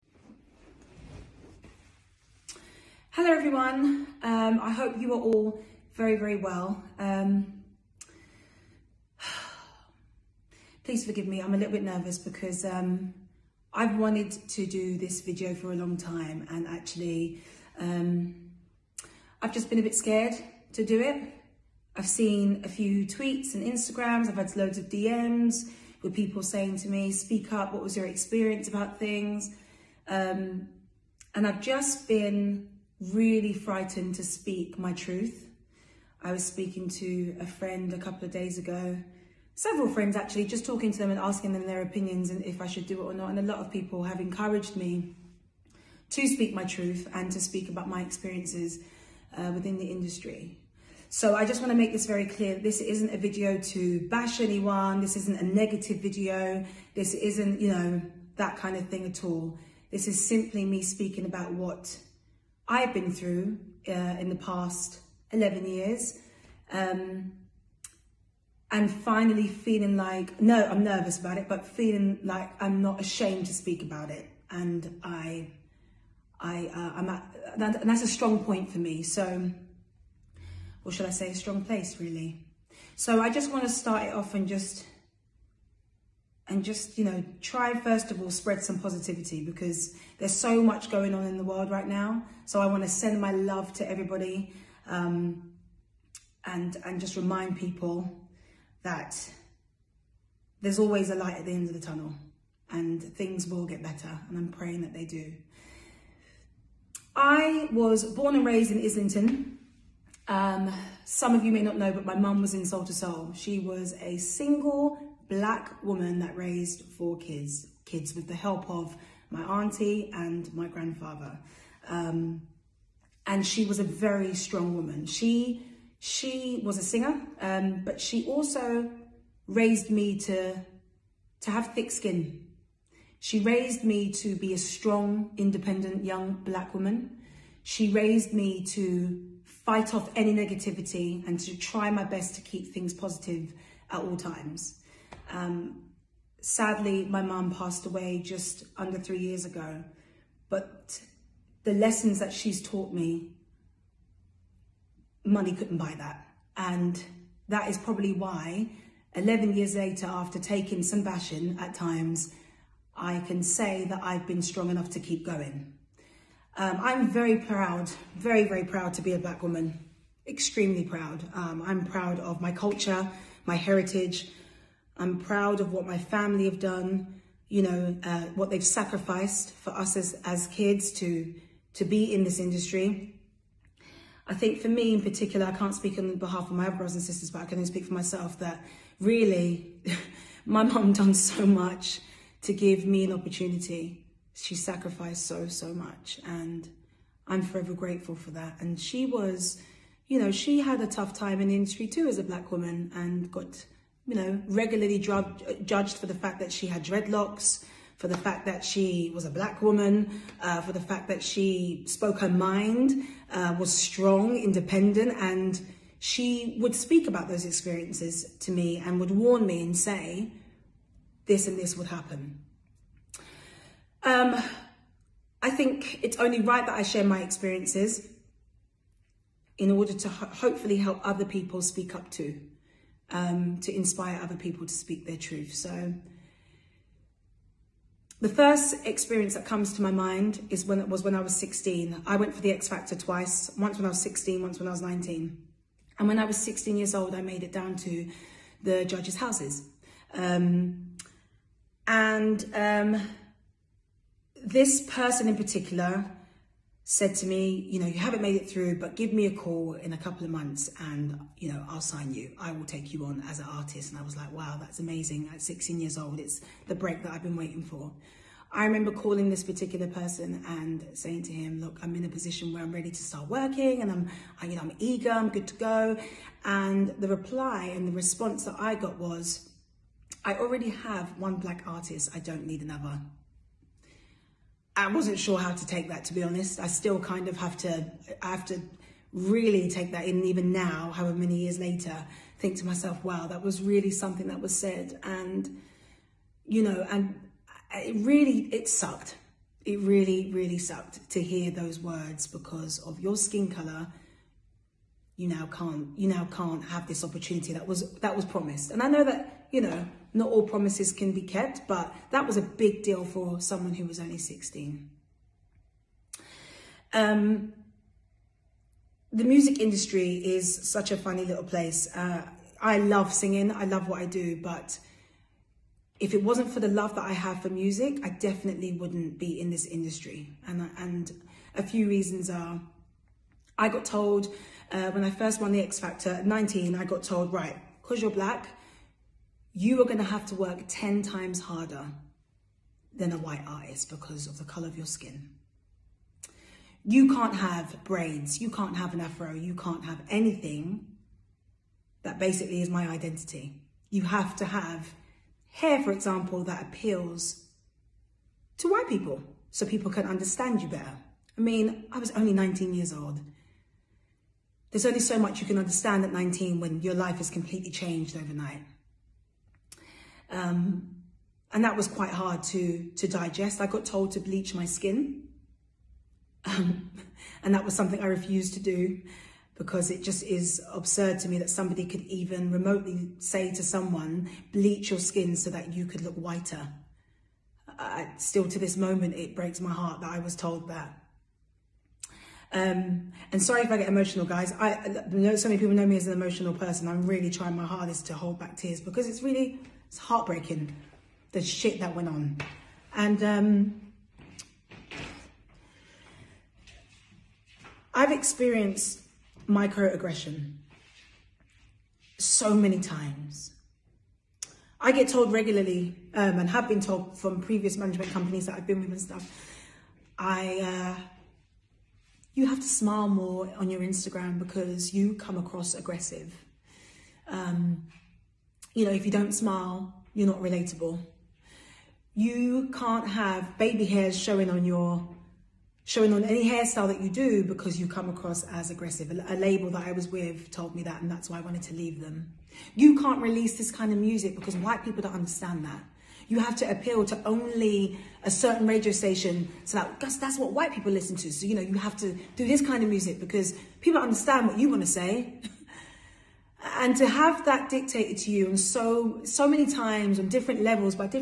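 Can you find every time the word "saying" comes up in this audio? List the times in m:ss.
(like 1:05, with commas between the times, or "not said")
0:26, 4:30.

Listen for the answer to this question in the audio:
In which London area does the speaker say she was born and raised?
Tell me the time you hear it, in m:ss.
1:48.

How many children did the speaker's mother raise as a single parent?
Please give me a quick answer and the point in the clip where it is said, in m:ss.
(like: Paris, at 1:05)
4, at 1:56.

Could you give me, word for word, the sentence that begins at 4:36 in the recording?
And the reply and the response that I got was, I already have one black artist.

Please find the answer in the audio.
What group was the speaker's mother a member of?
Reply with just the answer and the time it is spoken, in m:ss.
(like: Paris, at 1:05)
Soul II Soul, at 1:52.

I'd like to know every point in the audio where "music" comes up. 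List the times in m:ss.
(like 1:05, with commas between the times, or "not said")
5:19, 5:27, 7:23, 7:32.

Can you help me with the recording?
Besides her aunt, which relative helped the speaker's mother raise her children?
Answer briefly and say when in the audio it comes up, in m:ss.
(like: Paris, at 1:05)
Grandfather, at 2:00.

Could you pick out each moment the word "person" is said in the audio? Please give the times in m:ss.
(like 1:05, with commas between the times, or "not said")
4:14, 4:29, 6:36.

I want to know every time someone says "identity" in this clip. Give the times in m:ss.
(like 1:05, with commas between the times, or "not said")
5:52.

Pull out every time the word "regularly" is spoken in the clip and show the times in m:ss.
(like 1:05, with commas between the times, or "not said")
3:24, 6:55.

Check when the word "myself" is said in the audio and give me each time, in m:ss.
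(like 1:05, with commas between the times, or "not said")
3:07, 4:52.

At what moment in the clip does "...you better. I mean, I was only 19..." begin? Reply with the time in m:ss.
6:00.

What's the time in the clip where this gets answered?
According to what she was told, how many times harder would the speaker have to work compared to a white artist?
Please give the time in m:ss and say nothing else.
5:40.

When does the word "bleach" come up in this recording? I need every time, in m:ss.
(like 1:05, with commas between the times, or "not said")
6:14, 6:24.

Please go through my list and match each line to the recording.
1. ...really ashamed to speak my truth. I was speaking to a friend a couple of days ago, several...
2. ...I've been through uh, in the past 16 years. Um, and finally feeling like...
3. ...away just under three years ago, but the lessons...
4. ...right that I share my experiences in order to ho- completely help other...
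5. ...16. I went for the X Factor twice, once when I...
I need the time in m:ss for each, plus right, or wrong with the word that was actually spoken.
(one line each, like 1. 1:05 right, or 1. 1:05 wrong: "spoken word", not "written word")
1. 0:33 wrong: "frightened", not "ashamed"
2. 1:02 wrong: "11", not "16"
3. 2:27 right
4. 3:46 wrong: "hopefully", not "completely"
5. 4:01 right.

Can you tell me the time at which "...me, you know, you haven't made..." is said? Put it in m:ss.
4:17.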